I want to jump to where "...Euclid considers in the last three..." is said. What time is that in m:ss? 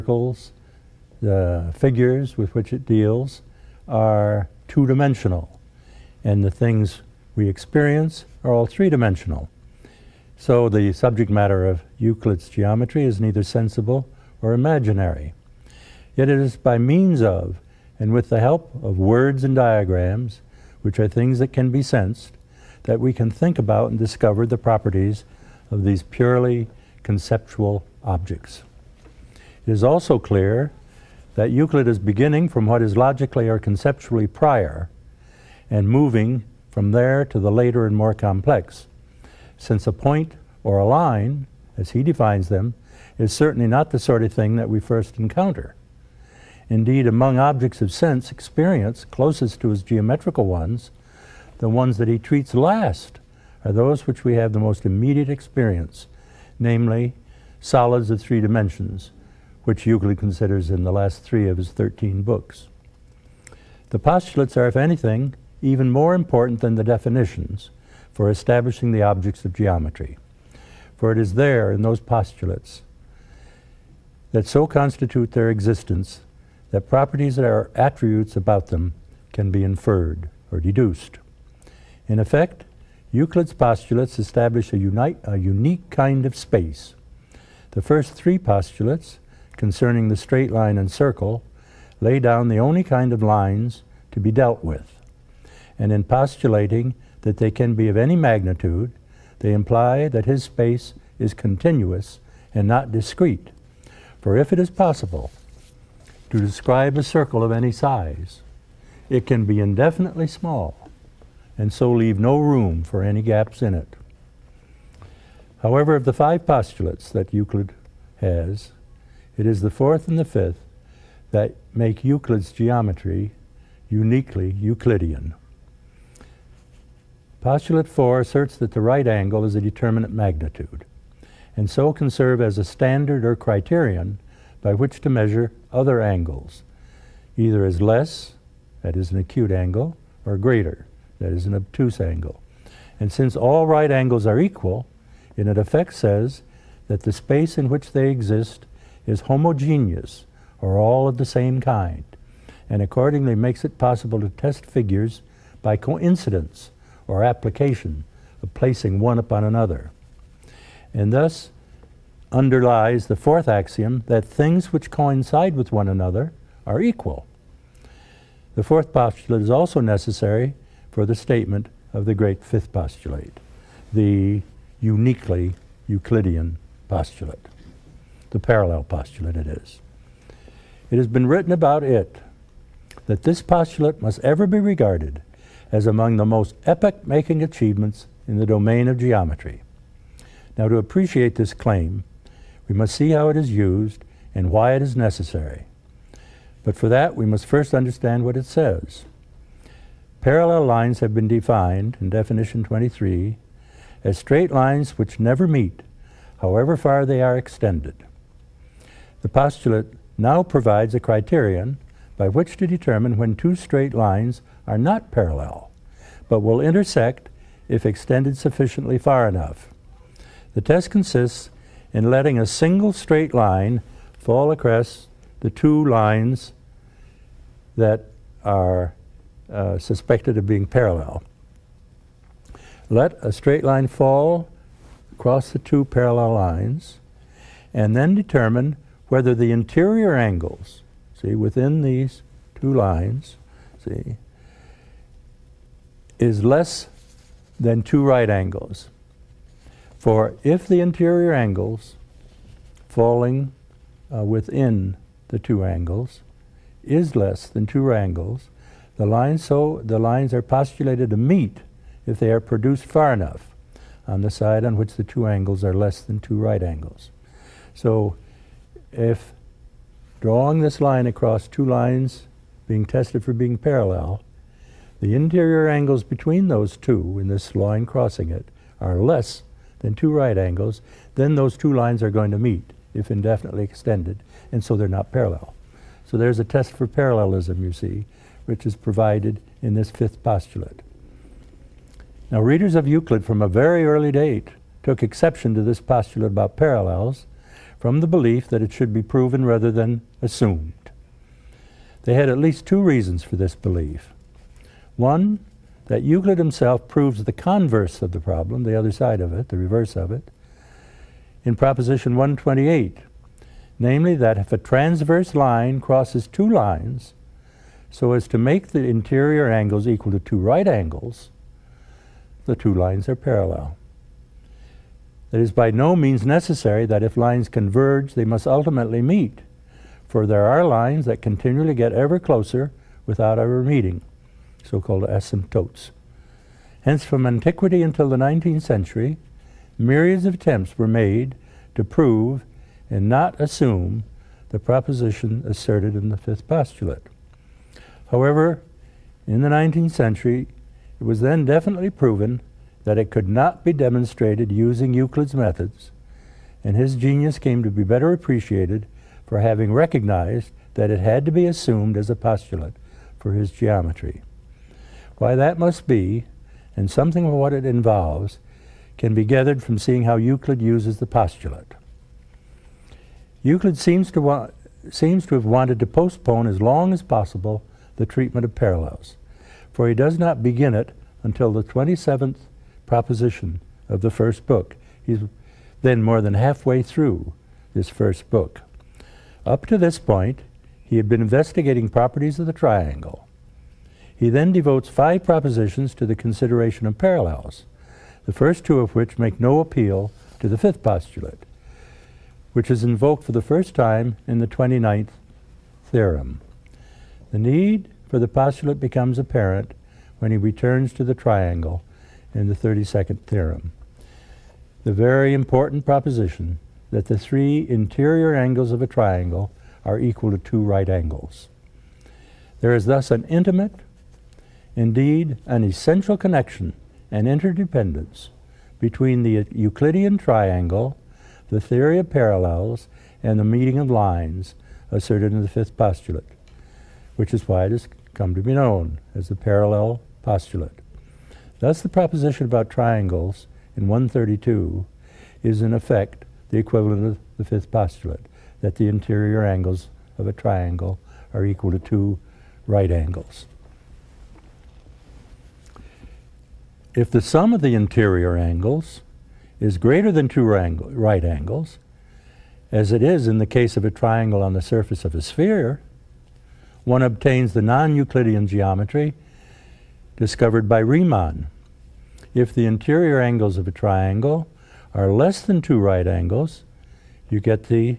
0:59.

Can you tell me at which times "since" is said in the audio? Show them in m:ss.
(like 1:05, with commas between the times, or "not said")
0:39, 2:23.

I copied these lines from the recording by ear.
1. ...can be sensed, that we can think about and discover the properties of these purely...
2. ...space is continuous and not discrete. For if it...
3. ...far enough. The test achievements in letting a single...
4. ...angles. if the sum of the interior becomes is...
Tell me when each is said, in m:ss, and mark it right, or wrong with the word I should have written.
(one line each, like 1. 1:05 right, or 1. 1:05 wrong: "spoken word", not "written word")
1. 0:21 right
2. 1:40 right
3. 3:38 wrong: "consists", not "achievements"
4. 7:32 wrong: "angles", not "becomes".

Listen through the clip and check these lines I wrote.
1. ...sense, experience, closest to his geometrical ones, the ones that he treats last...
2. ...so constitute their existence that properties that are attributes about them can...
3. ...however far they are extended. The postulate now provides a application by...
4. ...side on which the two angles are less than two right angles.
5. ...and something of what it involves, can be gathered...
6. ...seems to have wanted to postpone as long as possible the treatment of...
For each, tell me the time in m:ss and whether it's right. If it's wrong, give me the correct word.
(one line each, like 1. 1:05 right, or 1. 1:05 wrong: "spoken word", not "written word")
1. 0:47 right
2. 1:14 right
3. 3:26 wrong: "criterion", not "application"
4. 4:24 right
5. 6:06 right
6. 6:14 right.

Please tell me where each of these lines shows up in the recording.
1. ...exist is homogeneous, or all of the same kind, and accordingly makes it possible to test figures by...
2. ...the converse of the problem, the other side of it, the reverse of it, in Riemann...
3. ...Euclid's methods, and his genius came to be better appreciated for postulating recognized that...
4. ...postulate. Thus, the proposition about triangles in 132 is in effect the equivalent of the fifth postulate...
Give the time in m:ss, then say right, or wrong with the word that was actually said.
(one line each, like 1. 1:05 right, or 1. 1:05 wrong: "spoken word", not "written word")
1. 2:28 right
2. 5:07 wrong: "Proposition", not "Riemann"
3. 5:54 wrong: "having", not "postulating"
4. 7:20 right.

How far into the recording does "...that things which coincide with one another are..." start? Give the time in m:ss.
2:44.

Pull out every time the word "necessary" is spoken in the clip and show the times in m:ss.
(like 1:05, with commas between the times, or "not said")
2:49, 3:14, 5:26.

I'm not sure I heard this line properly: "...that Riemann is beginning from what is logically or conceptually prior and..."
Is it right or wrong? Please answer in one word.
wrong.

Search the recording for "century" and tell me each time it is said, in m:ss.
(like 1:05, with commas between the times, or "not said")
5:38, 5:49.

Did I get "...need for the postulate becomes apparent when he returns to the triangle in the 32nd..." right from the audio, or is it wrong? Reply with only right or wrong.
right.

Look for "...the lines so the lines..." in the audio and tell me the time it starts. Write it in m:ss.
4:18.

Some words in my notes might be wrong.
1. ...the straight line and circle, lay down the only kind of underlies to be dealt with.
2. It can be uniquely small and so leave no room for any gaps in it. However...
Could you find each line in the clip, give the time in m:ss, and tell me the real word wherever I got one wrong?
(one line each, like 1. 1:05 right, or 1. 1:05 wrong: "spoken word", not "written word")
1. 1:30 wrong: "lines", not "underlies"
2. 1:49 wrong: "indefinitely", not "uniquely".